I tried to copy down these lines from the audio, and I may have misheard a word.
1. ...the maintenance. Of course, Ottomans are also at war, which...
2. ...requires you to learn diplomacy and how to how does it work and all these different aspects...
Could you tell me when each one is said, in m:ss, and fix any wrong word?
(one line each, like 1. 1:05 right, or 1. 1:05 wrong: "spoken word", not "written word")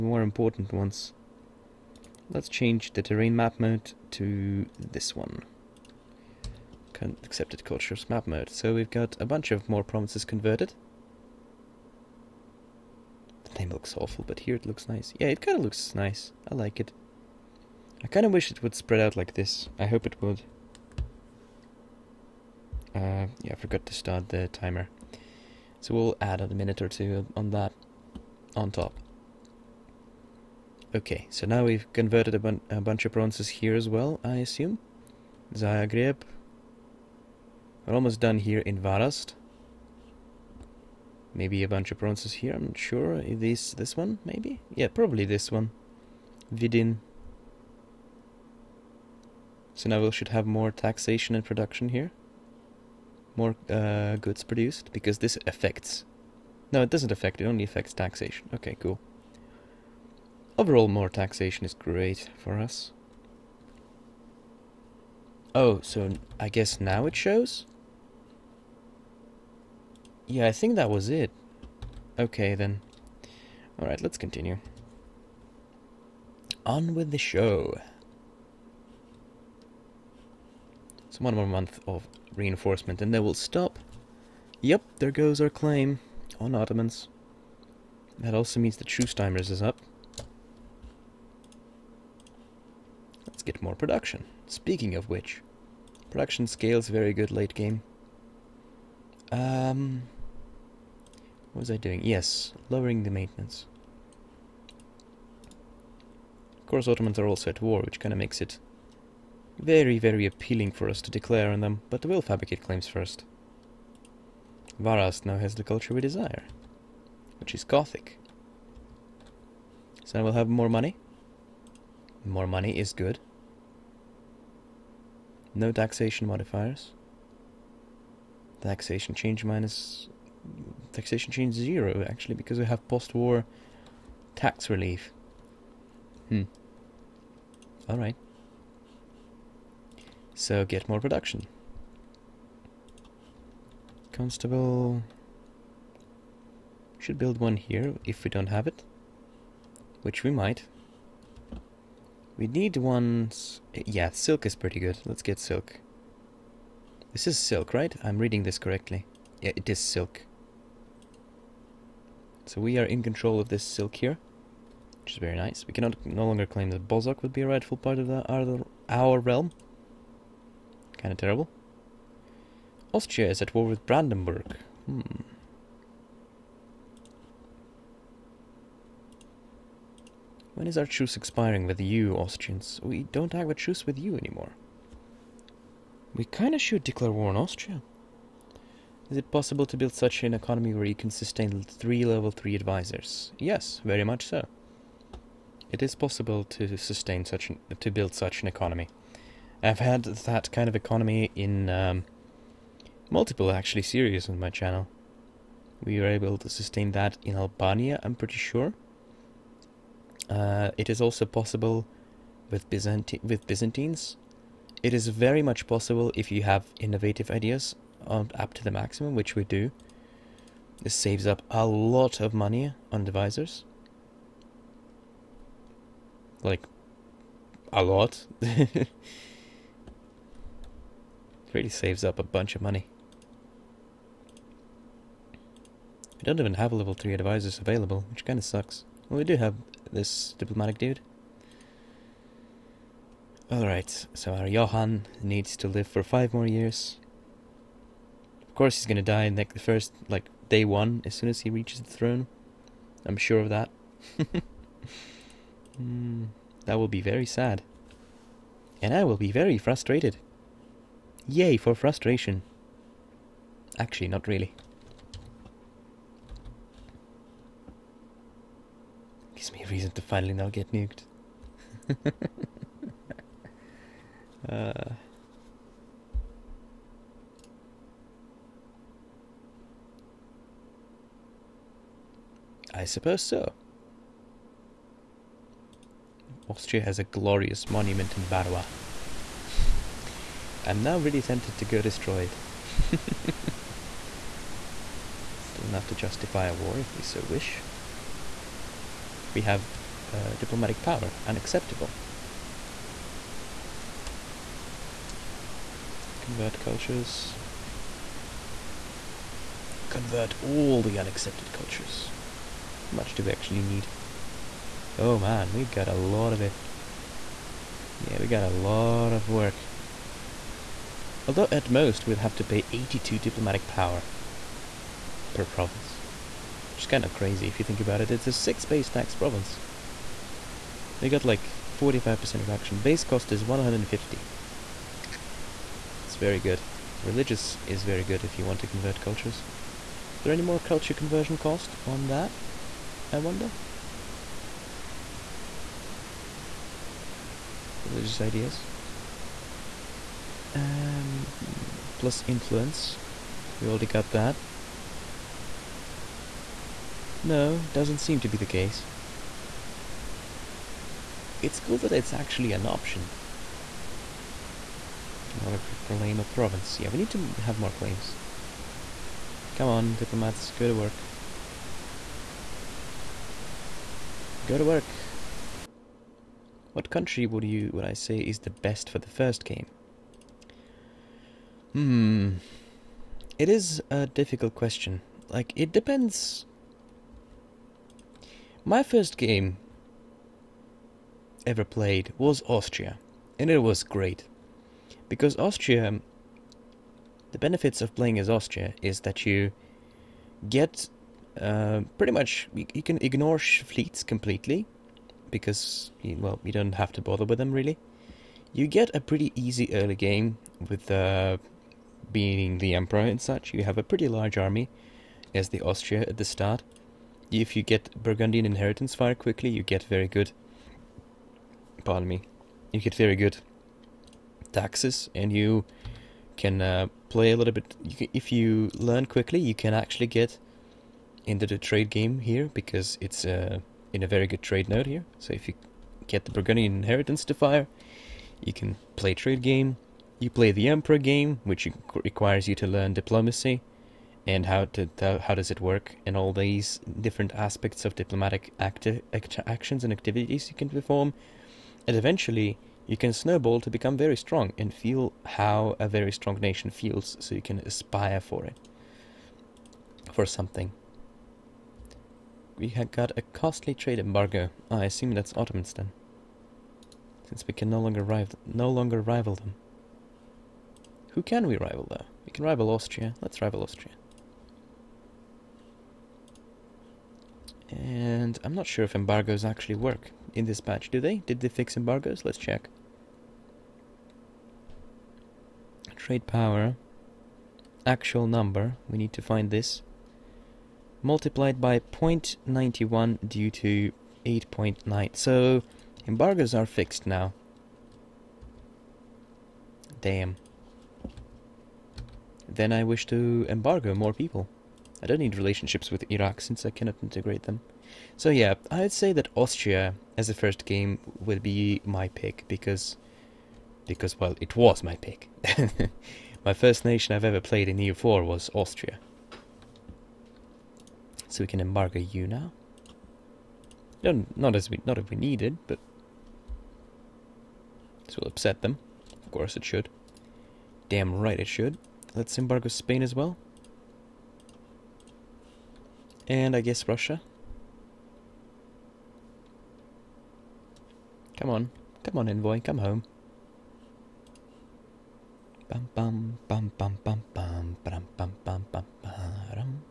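1. 1:43 right
2. 7:22 right.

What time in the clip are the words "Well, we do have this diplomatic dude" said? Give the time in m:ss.
3:59.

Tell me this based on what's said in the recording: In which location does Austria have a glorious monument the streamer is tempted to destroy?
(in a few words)
Barua.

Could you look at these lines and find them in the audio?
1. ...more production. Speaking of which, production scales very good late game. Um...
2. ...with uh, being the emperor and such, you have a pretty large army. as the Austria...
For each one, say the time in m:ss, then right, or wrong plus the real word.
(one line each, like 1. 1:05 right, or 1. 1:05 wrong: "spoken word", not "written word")
1. 1:33 right
2. 6:50 right.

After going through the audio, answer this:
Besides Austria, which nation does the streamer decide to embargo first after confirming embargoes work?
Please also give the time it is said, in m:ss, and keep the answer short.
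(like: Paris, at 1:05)
Spain, at 8:52.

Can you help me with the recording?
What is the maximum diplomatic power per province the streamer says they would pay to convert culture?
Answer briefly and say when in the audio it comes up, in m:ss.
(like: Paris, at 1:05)
82, at 5:22.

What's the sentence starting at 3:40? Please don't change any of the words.
This saves up a lot of money on advisors.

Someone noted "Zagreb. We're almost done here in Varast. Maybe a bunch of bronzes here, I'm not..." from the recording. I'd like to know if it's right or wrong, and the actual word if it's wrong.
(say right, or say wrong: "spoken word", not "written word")
right.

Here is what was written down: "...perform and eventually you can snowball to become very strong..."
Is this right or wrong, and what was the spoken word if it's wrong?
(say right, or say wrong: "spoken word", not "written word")
right.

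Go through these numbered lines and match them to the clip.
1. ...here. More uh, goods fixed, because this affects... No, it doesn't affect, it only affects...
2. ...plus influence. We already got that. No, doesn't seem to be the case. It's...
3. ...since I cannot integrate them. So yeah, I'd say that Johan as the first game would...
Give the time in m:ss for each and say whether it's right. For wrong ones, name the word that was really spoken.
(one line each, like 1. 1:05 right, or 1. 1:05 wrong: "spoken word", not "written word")
1. 0:51 wrong: "produced", not "fixed"
2. 5:51 right
3. 8:26 wrong: "Austria", not "Johan".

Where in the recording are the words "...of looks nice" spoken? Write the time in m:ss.
0:15.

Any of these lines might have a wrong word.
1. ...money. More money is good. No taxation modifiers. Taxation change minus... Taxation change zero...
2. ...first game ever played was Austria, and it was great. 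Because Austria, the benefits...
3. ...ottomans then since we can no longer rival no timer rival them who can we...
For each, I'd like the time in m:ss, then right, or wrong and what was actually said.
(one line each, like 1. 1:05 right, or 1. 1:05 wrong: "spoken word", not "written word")
1. 2:00 right
2. 6:28 right
3. 7:45 wrong: "longer", not "timer".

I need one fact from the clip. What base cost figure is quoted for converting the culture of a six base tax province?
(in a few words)
150.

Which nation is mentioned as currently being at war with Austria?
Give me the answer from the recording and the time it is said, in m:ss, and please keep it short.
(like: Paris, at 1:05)
Brandenburg, at 2:53.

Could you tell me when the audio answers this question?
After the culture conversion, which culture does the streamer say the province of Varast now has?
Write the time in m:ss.
1:57.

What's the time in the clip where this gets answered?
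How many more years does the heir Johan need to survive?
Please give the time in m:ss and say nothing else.
4:06.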